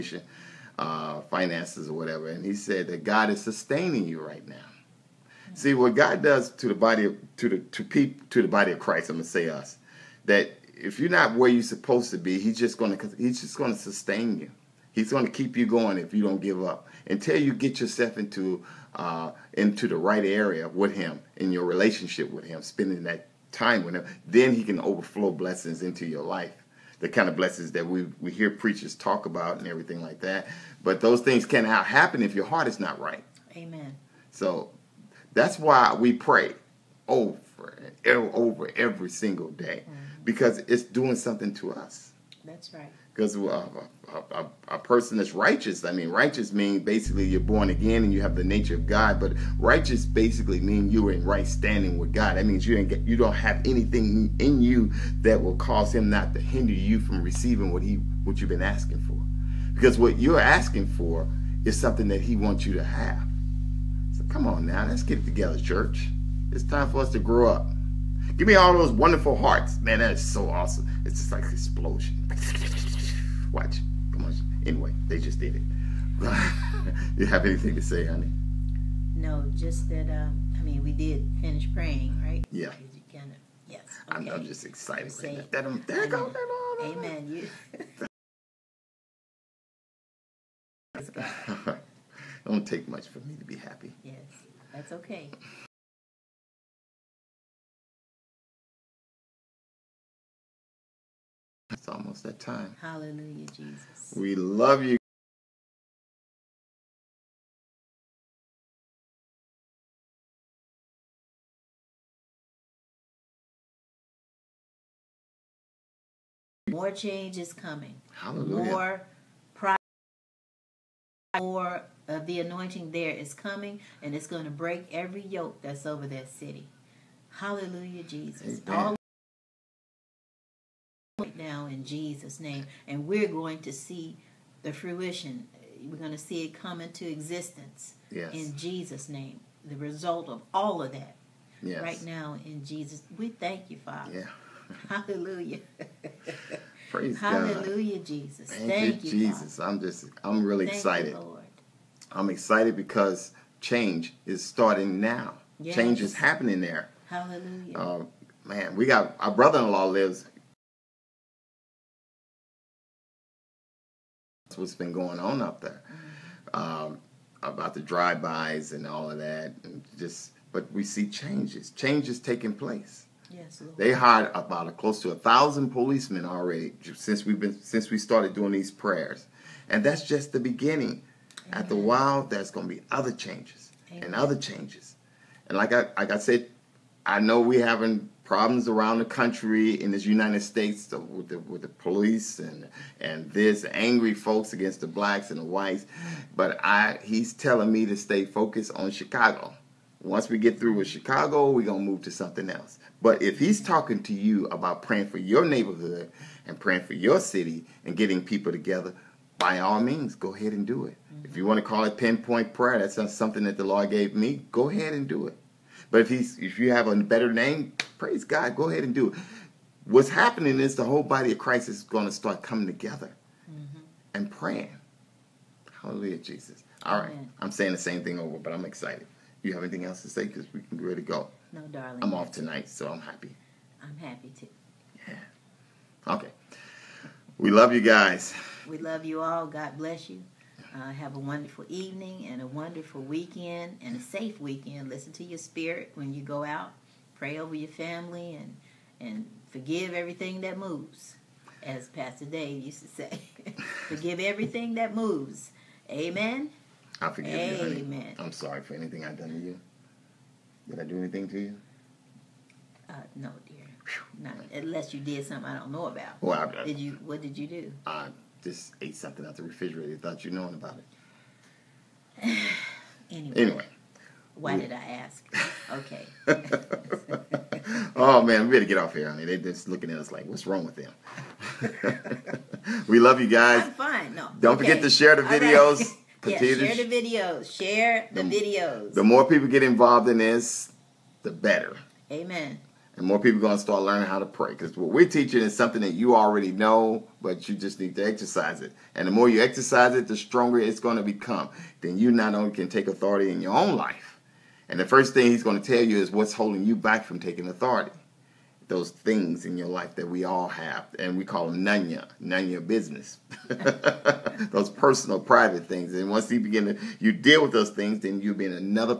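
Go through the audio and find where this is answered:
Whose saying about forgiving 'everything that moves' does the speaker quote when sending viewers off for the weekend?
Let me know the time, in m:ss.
4:11.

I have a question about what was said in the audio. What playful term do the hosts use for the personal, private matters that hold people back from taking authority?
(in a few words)
nanya business.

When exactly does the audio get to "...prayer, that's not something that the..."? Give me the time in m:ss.
3:32.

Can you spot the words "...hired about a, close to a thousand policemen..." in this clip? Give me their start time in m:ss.
2:53.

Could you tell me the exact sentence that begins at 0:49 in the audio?
But righteous basically means you are in right standing with God.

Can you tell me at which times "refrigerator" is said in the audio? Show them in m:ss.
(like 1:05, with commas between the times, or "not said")
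4:29.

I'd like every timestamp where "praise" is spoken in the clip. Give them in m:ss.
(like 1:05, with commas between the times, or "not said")
2:26, 3:37.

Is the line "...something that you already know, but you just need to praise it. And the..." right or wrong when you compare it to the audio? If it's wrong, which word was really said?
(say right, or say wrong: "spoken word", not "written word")
wrong: "exercise", not "praise".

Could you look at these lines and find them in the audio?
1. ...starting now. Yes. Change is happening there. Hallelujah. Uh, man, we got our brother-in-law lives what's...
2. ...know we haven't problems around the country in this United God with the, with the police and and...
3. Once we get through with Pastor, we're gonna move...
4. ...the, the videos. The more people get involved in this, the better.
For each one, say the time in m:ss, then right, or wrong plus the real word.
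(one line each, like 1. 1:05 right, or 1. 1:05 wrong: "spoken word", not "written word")
1. 2:34 right
2. 3:07 wrong: "States", not "God"
3. 3:20 wrong: "Chicago", not "Pastor"
4. 4:48 right.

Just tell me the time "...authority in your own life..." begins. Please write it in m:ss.
5:02.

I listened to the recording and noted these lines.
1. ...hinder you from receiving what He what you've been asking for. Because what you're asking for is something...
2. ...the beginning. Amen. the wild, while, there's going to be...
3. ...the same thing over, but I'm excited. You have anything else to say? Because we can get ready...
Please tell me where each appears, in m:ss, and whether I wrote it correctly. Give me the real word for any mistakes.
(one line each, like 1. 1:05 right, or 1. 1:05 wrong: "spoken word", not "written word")
1. 0:56 right
2. 3:00 right
3. 3:47 right.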